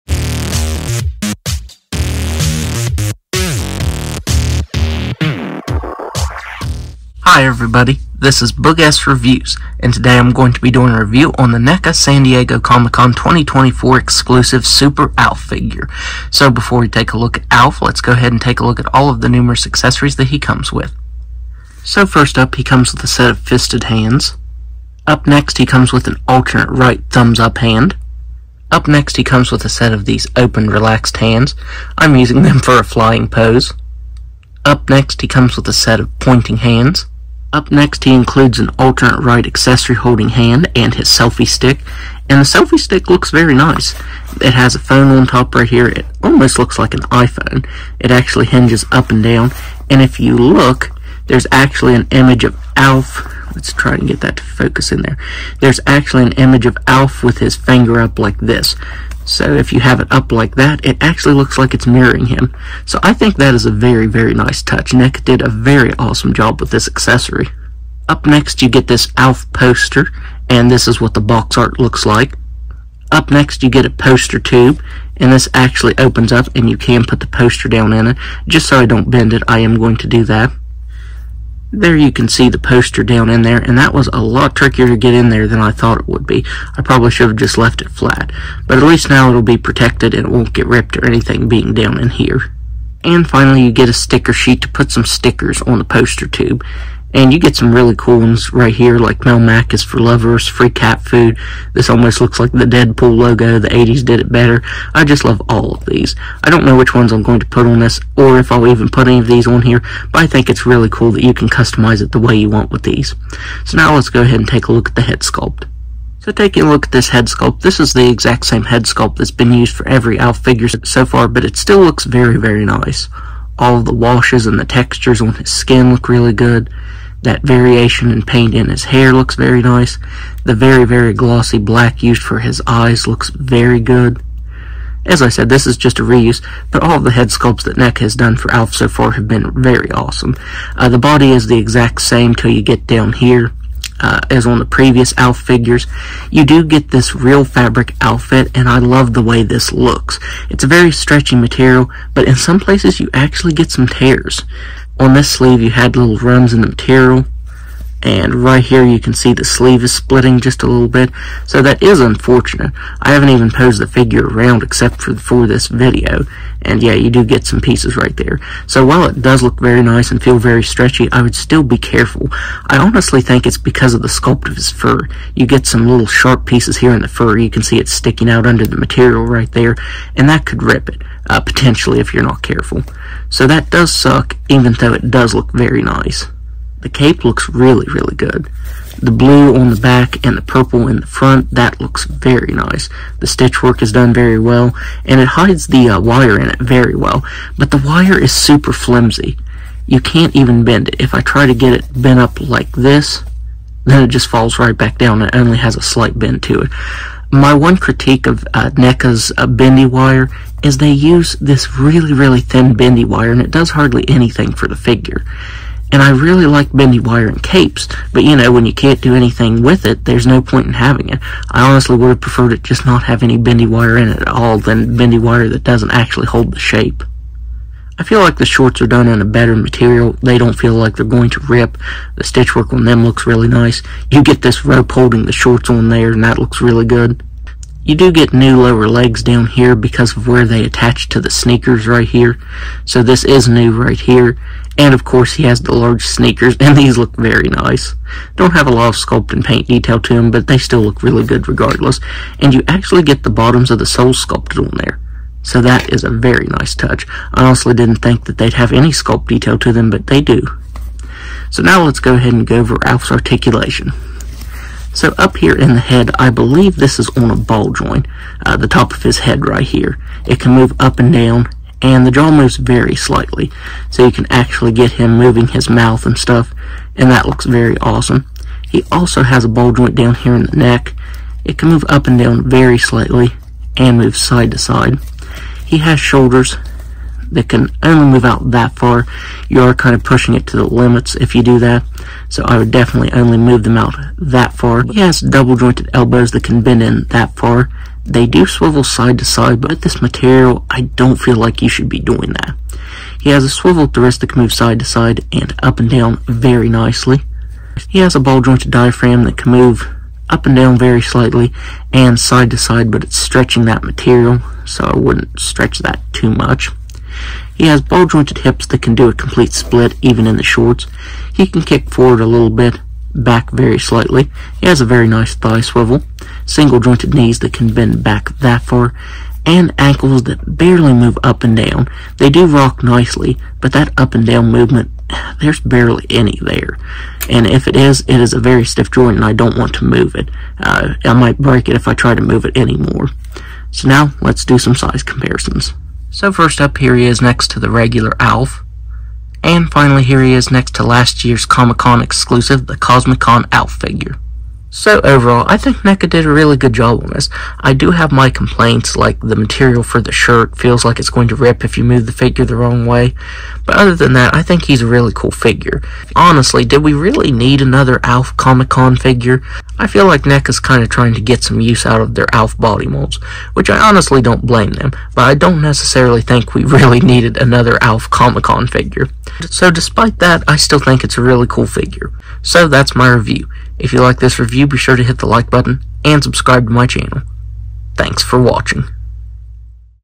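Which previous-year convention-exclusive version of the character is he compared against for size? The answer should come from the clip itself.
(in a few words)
Cosmicon ALF.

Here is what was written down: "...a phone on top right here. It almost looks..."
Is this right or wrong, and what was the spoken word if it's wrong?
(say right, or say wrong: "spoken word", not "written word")
right.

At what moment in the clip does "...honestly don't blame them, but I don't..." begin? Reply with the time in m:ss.
6:13.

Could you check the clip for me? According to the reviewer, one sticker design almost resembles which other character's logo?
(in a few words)
Deadpool.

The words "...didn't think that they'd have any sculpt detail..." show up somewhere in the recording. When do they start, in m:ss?
4:17.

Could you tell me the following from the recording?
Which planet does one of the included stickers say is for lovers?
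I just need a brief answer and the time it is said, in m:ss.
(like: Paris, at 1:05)
Melmac, at 1:39.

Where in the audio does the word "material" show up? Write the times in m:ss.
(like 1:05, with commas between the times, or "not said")
2:31, 2:36, 2:58, 3:49, 5:00, 5:13, 5:59.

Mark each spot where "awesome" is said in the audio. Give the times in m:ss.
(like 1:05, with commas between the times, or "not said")
1:05, 2:19, 4:37.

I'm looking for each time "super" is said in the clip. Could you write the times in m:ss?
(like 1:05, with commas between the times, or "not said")
0:14, 3:18.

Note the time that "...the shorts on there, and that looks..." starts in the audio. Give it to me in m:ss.
3:55.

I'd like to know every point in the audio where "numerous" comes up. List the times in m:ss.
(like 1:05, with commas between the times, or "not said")
0:19.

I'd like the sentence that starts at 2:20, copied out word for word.
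Uh, the body is the exact same till you get down here uh, as on the previous Alf figures.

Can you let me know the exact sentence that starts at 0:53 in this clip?
Let's try and get that to focus in there.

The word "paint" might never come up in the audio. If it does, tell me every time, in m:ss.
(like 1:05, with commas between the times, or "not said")
2:08, 4:09.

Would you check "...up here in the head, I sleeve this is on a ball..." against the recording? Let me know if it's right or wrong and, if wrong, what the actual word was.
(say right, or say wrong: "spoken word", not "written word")
wrong: "believe", not "sleeve".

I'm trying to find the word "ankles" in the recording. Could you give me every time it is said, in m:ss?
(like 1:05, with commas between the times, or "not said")
5:29.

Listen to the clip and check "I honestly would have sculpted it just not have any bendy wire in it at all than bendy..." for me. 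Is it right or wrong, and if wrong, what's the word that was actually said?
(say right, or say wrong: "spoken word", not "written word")
wrong: "preferred", not "sculpted".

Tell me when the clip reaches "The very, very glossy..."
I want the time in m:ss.
2:10.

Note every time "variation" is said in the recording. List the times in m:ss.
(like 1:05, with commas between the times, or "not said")
2:07.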